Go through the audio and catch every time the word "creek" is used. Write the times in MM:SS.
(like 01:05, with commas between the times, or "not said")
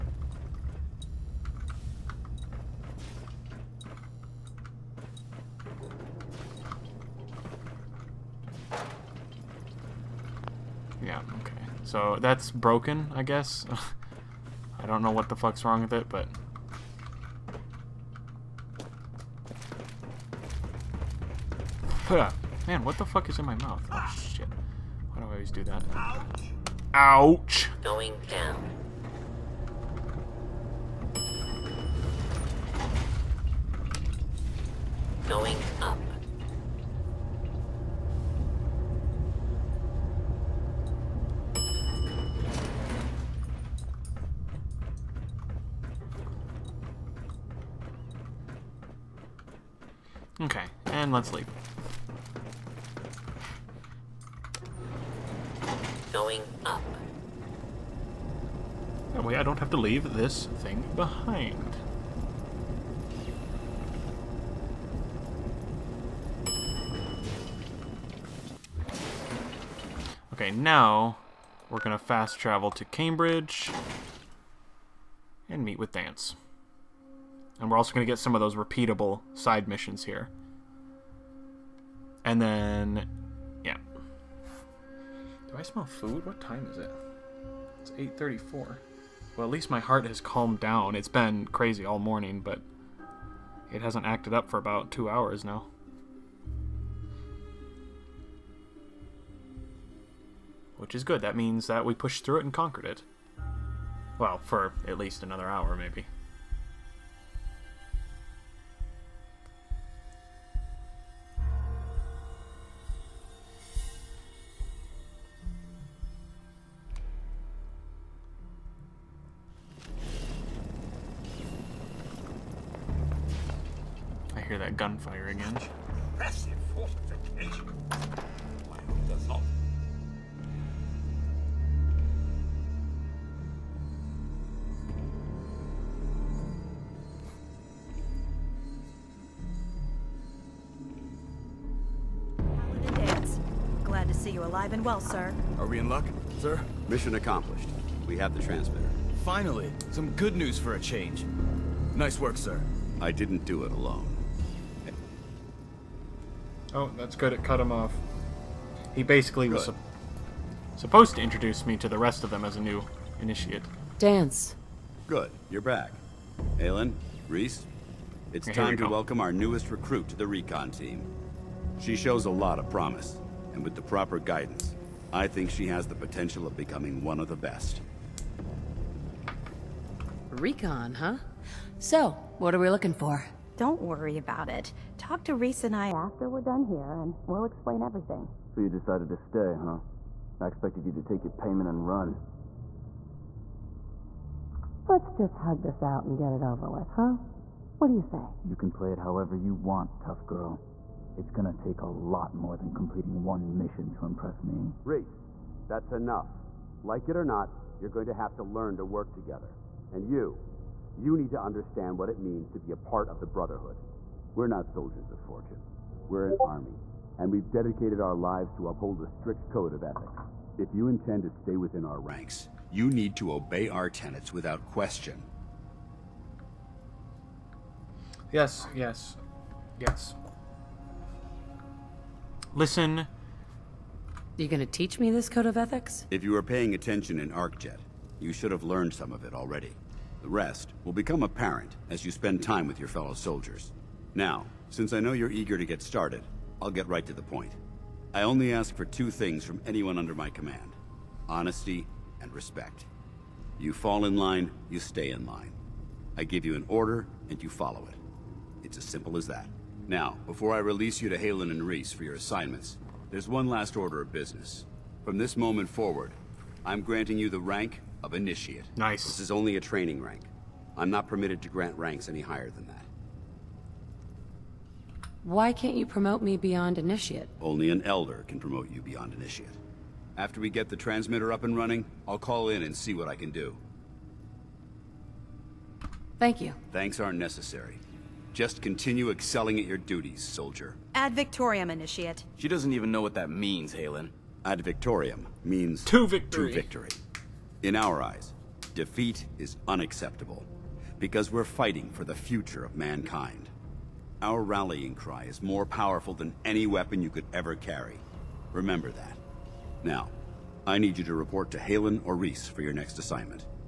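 not said.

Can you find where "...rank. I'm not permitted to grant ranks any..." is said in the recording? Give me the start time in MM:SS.
04:30.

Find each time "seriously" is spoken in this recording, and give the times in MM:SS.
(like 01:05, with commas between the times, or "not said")
not said.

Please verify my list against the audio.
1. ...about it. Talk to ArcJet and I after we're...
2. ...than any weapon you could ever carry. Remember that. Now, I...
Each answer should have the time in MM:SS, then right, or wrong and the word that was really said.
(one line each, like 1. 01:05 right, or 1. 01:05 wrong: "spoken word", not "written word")
1. 03:04 wrong: "Rhys", not "ArcJet"
2. 05:06 right.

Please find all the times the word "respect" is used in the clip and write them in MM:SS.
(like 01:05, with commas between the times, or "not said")
04:12.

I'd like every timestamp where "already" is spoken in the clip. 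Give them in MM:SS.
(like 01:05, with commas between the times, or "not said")
03:59.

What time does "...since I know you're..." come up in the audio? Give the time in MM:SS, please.
04:04.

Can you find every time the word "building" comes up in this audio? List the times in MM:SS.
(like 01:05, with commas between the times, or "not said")
not said.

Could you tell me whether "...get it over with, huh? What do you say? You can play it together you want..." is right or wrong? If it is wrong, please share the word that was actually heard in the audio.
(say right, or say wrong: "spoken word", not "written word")
wrong: "however", not "together".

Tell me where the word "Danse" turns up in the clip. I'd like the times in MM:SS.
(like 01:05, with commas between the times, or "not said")
01:15, 02:43.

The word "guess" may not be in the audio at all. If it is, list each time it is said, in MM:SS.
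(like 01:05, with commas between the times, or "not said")
00:13.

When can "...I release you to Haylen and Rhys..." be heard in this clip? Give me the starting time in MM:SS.
04:20.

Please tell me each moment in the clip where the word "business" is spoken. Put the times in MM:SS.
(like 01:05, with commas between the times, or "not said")
04:24.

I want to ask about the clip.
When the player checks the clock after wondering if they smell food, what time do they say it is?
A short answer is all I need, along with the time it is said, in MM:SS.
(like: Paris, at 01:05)
8:34, at 01:27.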